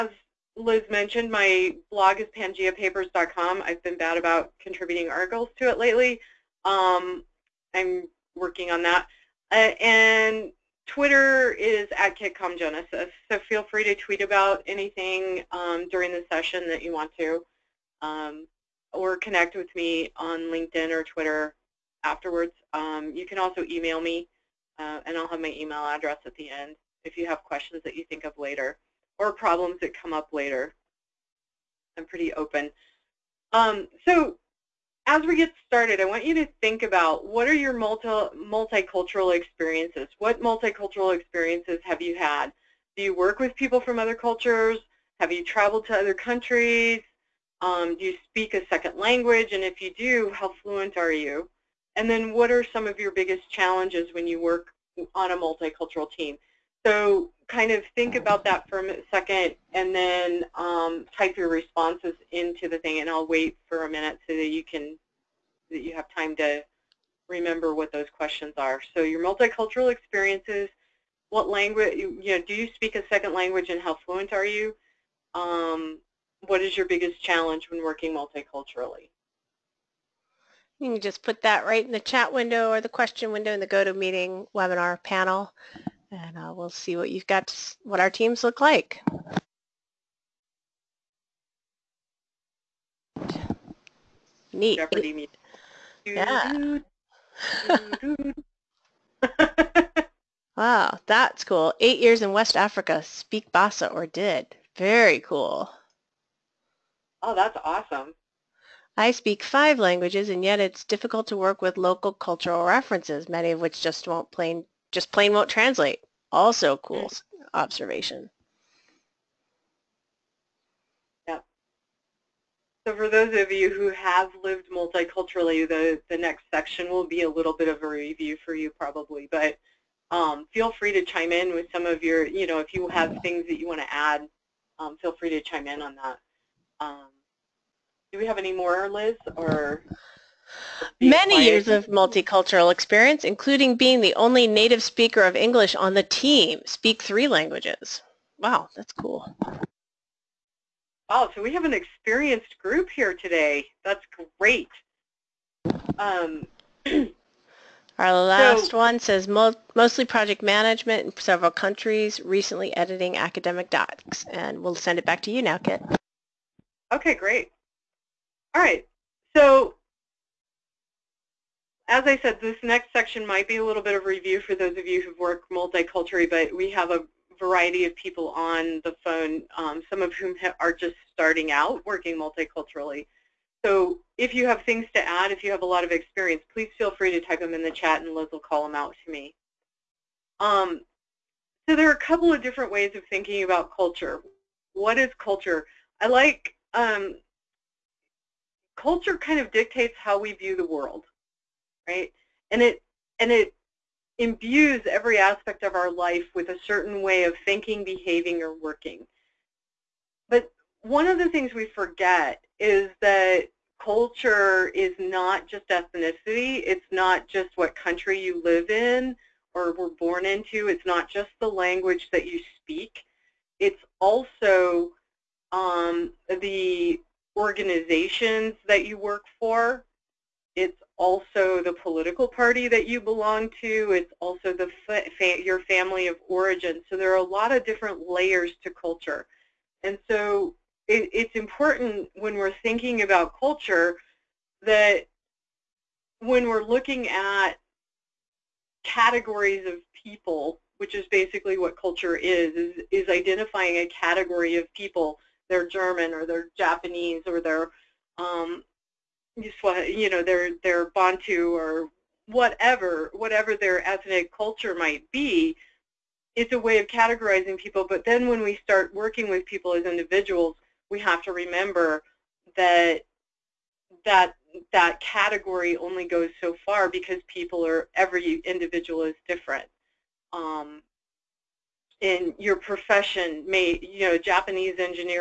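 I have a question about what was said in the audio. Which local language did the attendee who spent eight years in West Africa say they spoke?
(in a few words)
Bassa.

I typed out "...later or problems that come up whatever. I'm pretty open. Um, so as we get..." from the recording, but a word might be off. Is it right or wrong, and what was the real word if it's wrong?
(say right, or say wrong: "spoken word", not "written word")
wrong: "later", not "whatever".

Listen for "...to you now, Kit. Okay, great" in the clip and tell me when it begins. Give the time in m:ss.
2:45.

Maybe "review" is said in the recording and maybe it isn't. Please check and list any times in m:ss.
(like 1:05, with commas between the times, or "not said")
2:07, 2:54.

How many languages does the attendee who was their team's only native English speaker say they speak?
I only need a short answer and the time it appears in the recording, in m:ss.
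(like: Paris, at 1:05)
3, at 2:27.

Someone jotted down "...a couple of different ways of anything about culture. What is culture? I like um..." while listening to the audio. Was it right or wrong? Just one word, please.
wrong.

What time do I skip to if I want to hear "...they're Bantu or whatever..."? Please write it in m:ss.
4:20.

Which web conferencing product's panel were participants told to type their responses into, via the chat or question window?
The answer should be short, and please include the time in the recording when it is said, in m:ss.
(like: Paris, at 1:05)
GoToMeeting, at 1:23.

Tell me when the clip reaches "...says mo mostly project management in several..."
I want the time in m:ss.
2:38.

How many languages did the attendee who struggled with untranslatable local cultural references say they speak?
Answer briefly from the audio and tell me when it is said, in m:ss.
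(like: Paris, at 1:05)
5, at 1:49.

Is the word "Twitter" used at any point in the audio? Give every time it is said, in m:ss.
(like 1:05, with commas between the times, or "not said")
0:10, 0:21.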